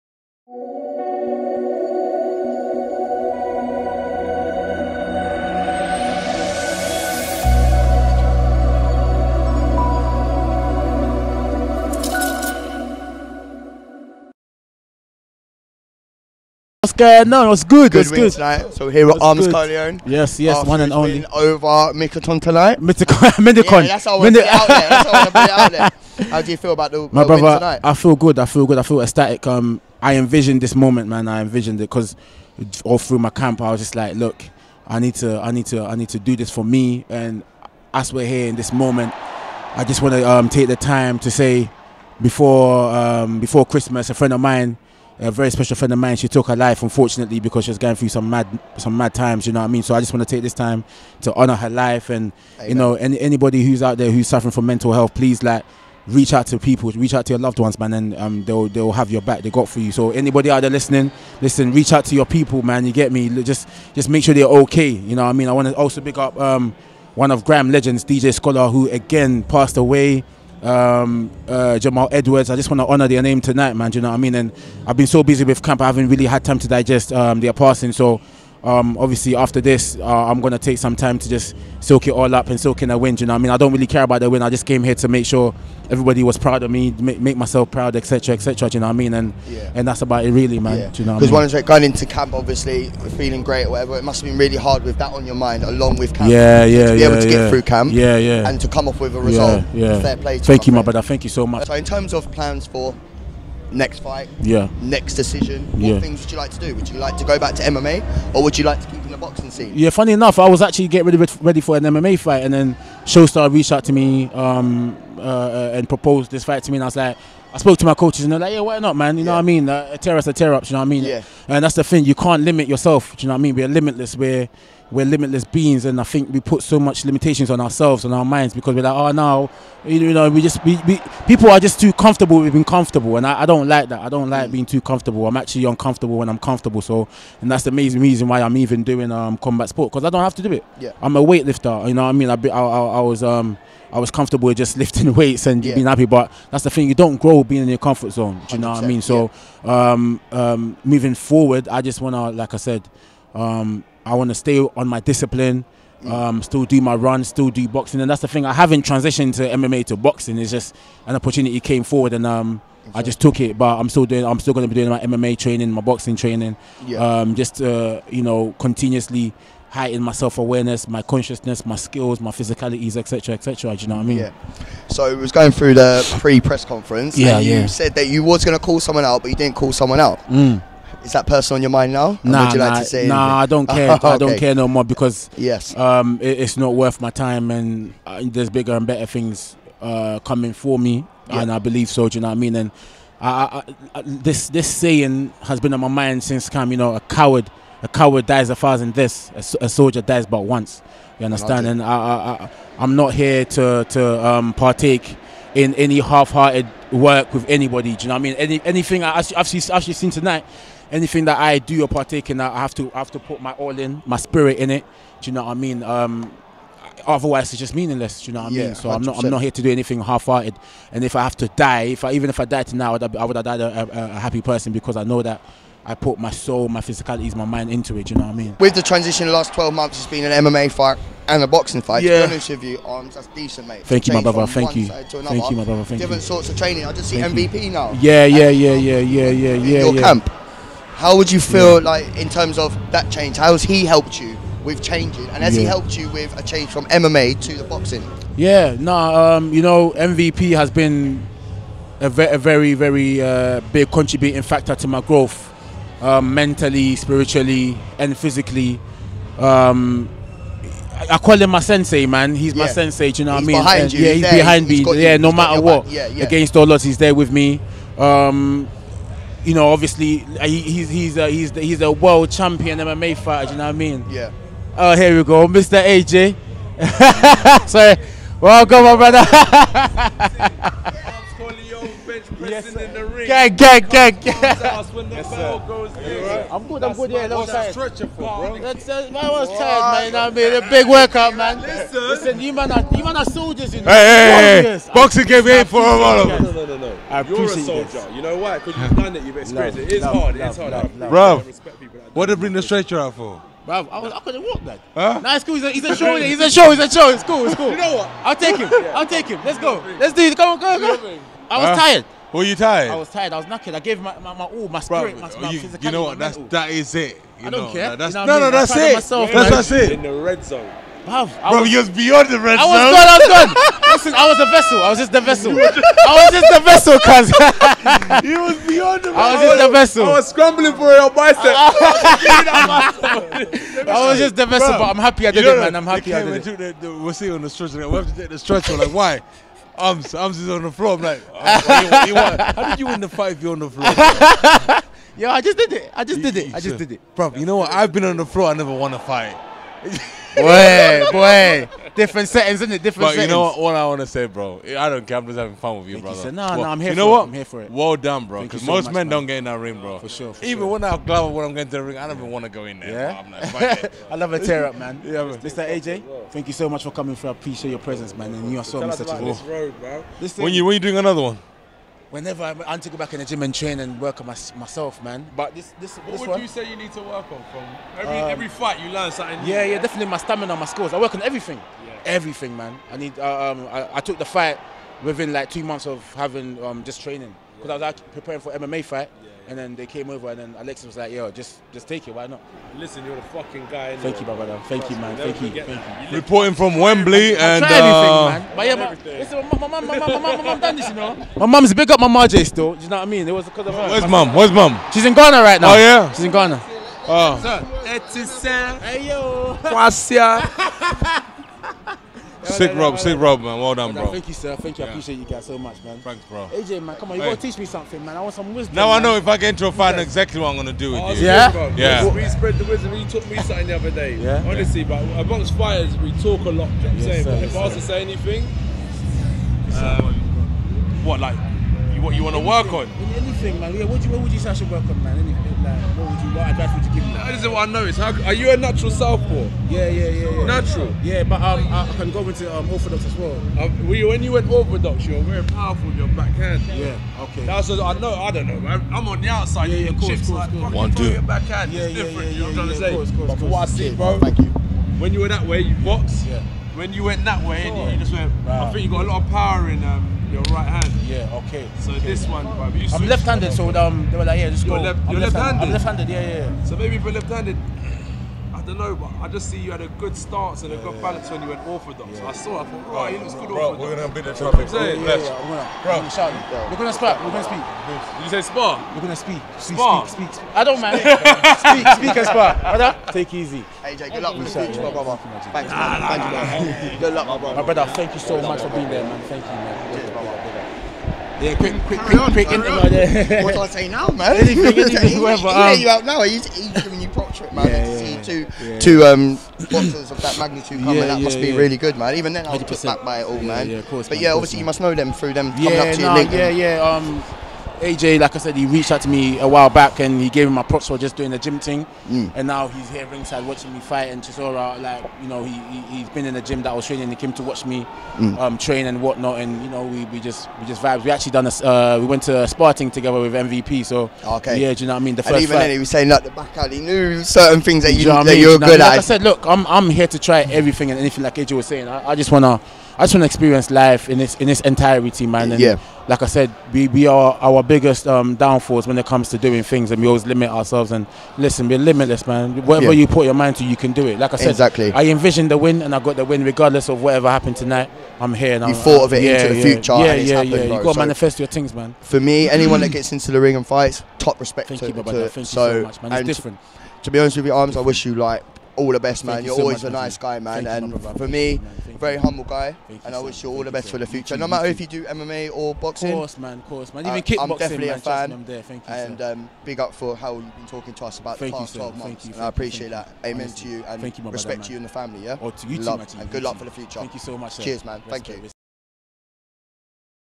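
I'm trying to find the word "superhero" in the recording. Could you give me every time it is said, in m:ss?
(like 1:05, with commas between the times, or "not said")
not said.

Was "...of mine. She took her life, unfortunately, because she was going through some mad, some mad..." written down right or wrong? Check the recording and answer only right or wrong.
right.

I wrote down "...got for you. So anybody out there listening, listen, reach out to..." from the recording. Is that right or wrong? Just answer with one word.
right.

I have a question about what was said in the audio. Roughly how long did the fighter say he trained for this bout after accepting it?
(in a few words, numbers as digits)
2 months.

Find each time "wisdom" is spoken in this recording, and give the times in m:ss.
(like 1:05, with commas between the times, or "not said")
6:58, 7:02.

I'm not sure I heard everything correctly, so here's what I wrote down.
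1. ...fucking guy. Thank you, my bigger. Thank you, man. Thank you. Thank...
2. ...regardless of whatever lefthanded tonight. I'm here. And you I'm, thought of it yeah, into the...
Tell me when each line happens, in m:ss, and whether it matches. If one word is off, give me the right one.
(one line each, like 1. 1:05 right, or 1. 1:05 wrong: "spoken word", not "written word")
1. 6:33 wrong: "brother", not "bigger"
2. 9:06 wrong: "happened", not "lefthanded".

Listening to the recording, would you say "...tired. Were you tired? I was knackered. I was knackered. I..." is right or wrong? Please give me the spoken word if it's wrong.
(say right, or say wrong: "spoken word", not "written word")
wrong: "tired", not "knackered".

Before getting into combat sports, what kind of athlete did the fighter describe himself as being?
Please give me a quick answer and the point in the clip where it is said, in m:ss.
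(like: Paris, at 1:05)
A weightlifter, at 2:21.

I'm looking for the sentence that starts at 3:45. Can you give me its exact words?
I put my soul, my physicalities, my mind into it.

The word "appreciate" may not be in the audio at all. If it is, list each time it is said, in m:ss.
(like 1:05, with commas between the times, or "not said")
6:07, 6:54, 9:32.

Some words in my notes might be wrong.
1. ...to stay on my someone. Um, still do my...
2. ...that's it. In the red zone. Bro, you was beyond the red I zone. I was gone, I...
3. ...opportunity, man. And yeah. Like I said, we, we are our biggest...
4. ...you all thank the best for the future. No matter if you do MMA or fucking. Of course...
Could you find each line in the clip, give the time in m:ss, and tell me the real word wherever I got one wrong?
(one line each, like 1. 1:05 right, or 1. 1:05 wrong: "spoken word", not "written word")
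1. 2:34 wrong: "discipline", not "someone"
2. 5:19 right
3. 8:54 wrong: "entirety", not "opportunity"
4. 9:23 wrong: "boxing", not "fucking".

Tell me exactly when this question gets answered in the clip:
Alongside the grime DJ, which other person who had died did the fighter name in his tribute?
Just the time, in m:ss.
1:11.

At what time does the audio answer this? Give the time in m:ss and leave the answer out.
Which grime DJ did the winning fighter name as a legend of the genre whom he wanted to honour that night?
1:08.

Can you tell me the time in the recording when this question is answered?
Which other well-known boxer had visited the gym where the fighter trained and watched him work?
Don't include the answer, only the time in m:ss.
8:34.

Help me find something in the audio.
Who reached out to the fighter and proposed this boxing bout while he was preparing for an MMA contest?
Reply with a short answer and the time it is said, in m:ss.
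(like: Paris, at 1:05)
Showstar, at 1:53.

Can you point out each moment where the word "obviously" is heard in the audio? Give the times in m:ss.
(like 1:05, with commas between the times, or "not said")
1:18, 1:32, 4:29, 8:24.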